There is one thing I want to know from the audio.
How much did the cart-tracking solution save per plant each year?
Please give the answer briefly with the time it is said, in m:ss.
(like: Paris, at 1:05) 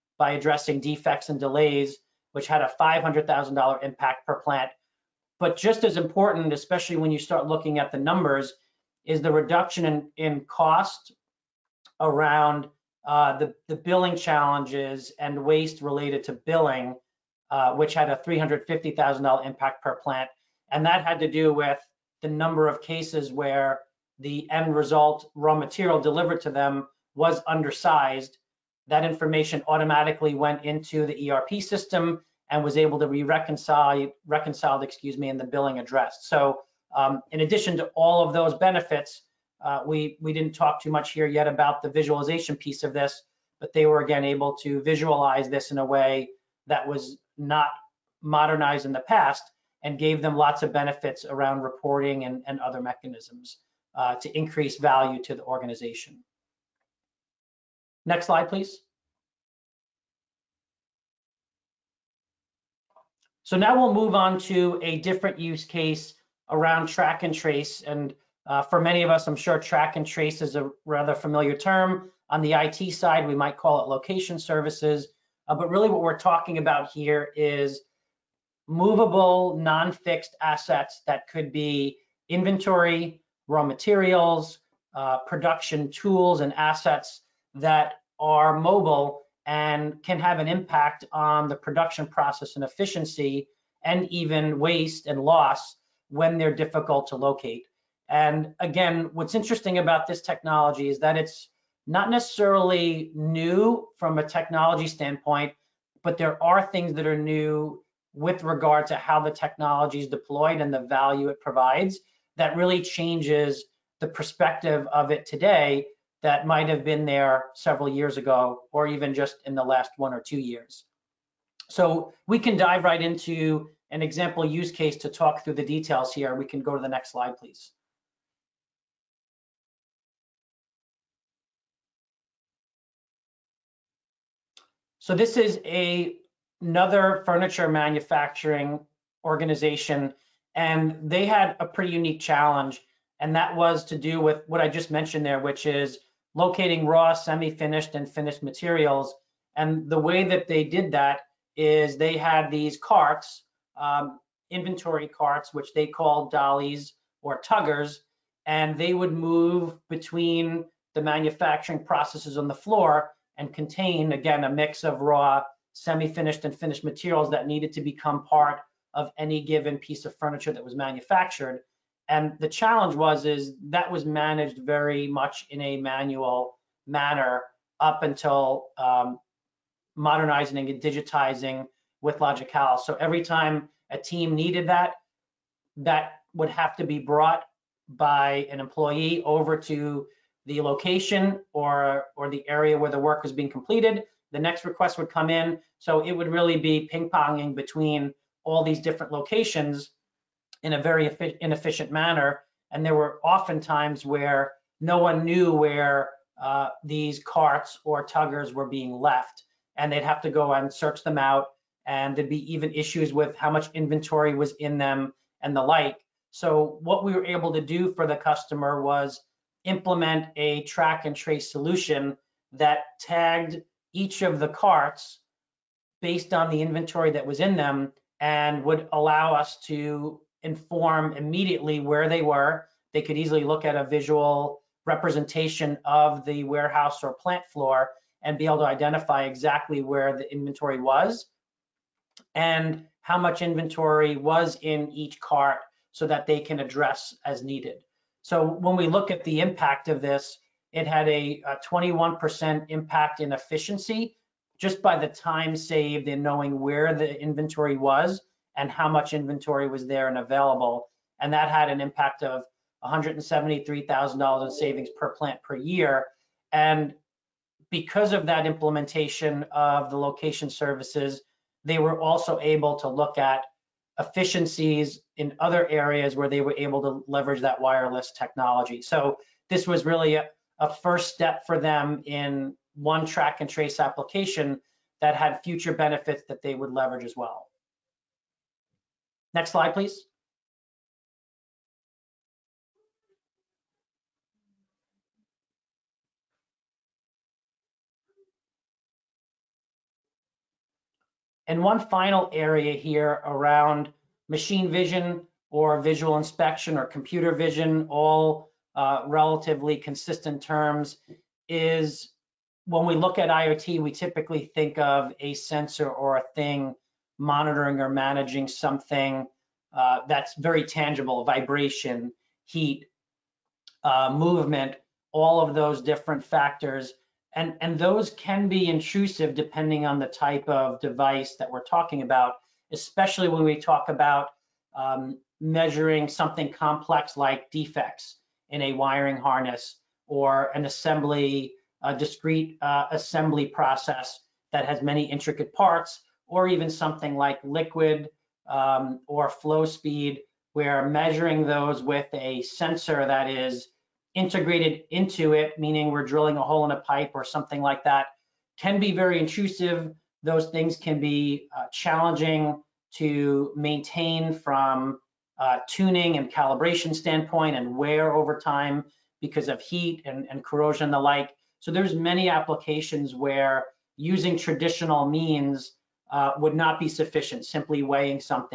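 $173,000, at 4:22.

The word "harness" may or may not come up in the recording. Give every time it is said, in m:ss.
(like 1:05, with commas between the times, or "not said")
5:39.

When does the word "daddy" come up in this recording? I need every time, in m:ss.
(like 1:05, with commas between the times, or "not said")
not said.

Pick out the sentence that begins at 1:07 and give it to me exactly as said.
And uh, for many of us, I'm sure track and trace is a rather familiar term.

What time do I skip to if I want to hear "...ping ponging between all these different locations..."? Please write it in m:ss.
3:16.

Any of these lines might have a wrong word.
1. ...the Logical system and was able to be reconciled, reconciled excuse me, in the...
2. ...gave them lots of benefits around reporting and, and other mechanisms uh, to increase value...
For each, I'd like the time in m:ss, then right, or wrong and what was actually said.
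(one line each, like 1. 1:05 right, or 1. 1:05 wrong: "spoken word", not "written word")
1. 0:31 wrong: "ERP", not "Logical"
2. 0:49 right.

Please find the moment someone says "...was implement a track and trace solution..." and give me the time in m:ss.
3:38.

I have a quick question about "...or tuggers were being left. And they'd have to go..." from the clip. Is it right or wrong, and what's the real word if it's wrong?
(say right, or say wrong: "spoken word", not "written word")
right.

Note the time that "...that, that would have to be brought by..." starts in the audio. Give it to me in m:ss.
3:04.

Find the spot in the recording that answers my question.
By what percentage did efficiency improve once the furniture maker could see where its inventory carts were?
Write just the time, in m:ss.
4:11.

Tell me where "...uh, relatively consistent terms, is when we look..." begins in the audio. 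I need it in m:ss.
5:08.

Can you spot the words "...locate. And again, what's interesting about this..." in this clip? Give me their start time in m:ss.
1:37.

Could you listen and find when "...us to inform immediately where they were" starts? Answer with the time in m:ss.
3:49.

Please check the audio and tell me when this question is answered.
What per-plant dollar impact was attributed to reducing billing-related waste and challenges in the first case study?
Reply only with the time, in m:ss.
0:18.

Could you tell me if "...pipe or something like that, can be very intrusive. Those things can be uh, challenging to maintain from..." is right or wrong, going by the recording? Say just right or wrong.
right.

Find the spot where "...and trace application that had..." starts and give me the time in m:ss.
4:43.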